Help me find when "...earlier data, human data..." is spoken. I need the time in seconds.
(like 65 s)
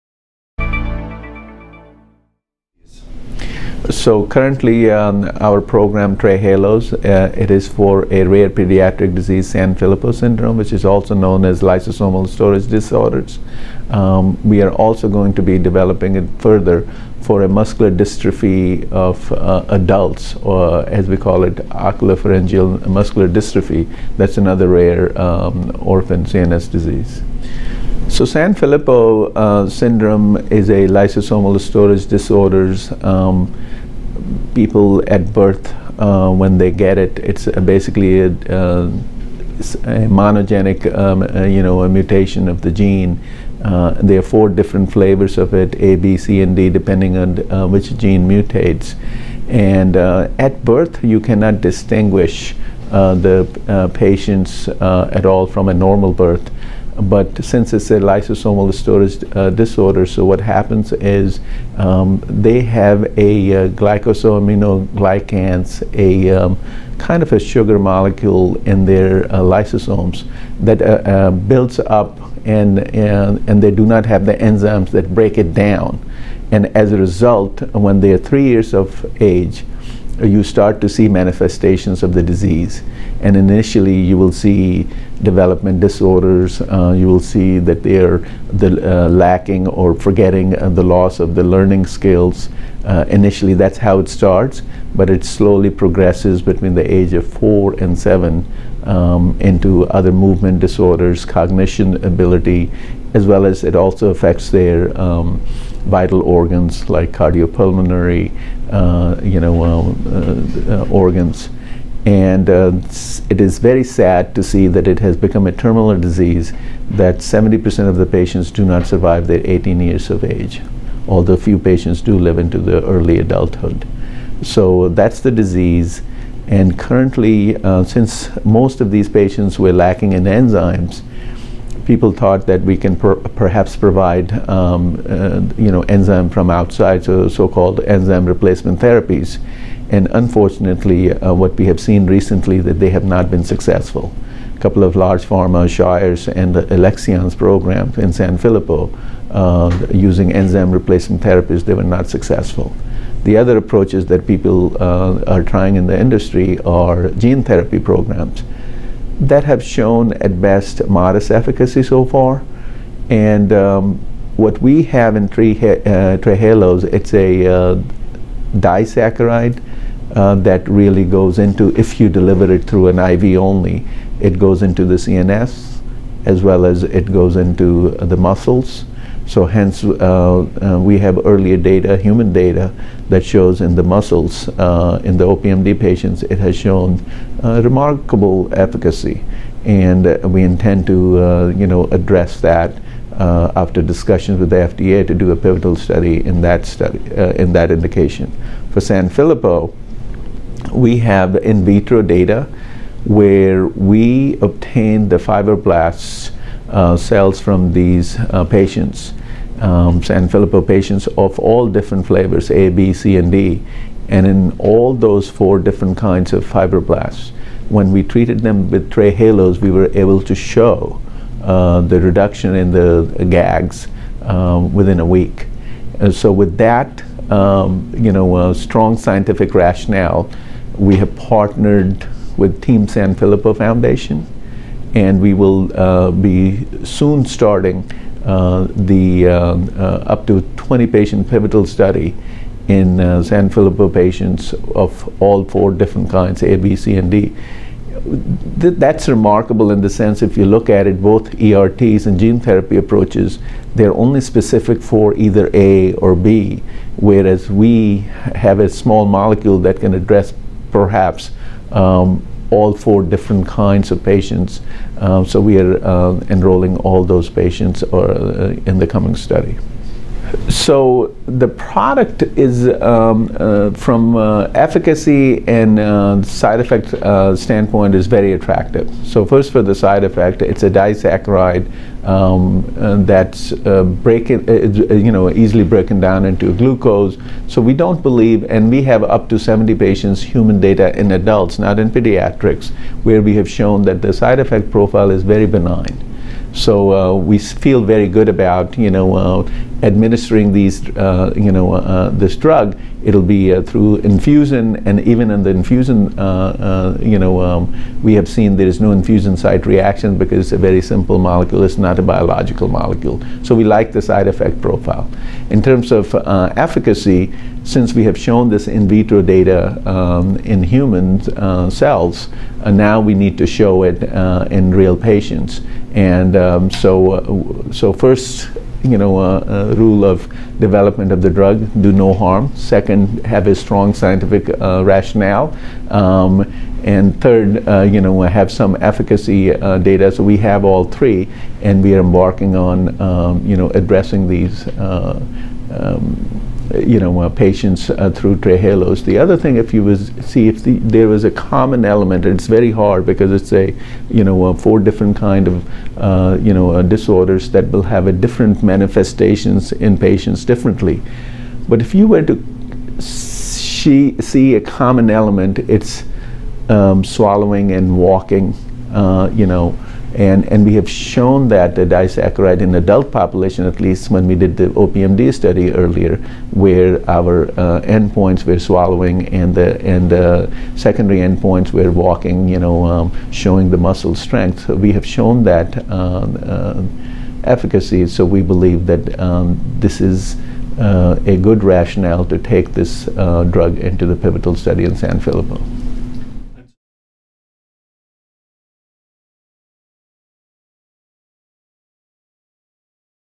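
181 s.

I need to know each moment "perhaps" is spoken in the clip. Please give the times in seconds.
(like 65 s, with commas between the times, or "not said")
133 s, 260 s.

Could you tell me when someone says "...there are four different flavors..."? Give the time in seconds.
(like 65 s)
44 s.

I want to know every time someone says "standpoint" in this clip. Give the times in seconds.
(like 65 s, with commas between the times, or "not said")
277 s.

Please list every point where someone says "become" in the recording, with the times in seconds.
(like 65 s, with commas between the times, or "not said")
115 s.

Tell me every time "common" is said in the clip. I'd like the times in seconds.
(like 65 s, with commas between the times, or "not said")
351 s, 364 s.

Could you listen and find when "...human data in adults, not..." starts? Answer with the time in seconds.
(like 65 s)
290 s.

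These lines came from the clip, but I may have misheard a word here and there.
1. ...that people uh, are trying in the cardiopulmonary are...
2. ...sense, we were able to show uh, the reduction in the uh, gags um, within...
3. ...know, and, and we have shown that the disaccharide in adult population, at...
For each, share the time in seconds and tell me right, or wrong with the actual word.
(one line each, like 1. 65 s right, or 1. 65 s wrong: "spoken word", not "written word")
1. 154 s wrong: "industry", not "cardiopulmonary"
2. 218 s wrong: "trehalose", not "sense"
3. 369 s right.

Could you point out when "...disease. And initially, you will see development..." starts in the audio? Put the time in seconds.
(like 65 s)
82 s.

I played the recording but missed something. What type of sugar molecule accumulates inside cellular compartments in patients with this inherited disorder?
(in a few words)
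glycosaminoglycans.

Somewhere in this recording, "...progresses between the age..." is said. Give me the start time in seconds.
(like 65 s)
95 s.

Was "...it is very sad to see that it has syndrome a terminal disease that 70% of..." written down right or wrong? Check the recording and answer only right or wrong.
wrong.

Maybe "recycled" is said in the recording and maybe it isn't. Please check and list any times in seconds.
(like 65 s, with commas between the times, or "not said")
not said.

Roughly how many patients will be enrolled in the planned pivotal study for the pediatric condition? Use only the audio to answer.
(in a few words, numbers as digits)
up to 20.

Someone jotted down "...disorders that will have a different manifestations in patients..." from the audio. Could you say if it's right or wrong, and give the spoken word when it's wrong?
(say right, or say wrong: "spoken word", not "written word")
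right.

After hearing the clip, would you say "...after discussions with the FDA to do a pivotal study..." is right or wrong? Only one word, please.
right.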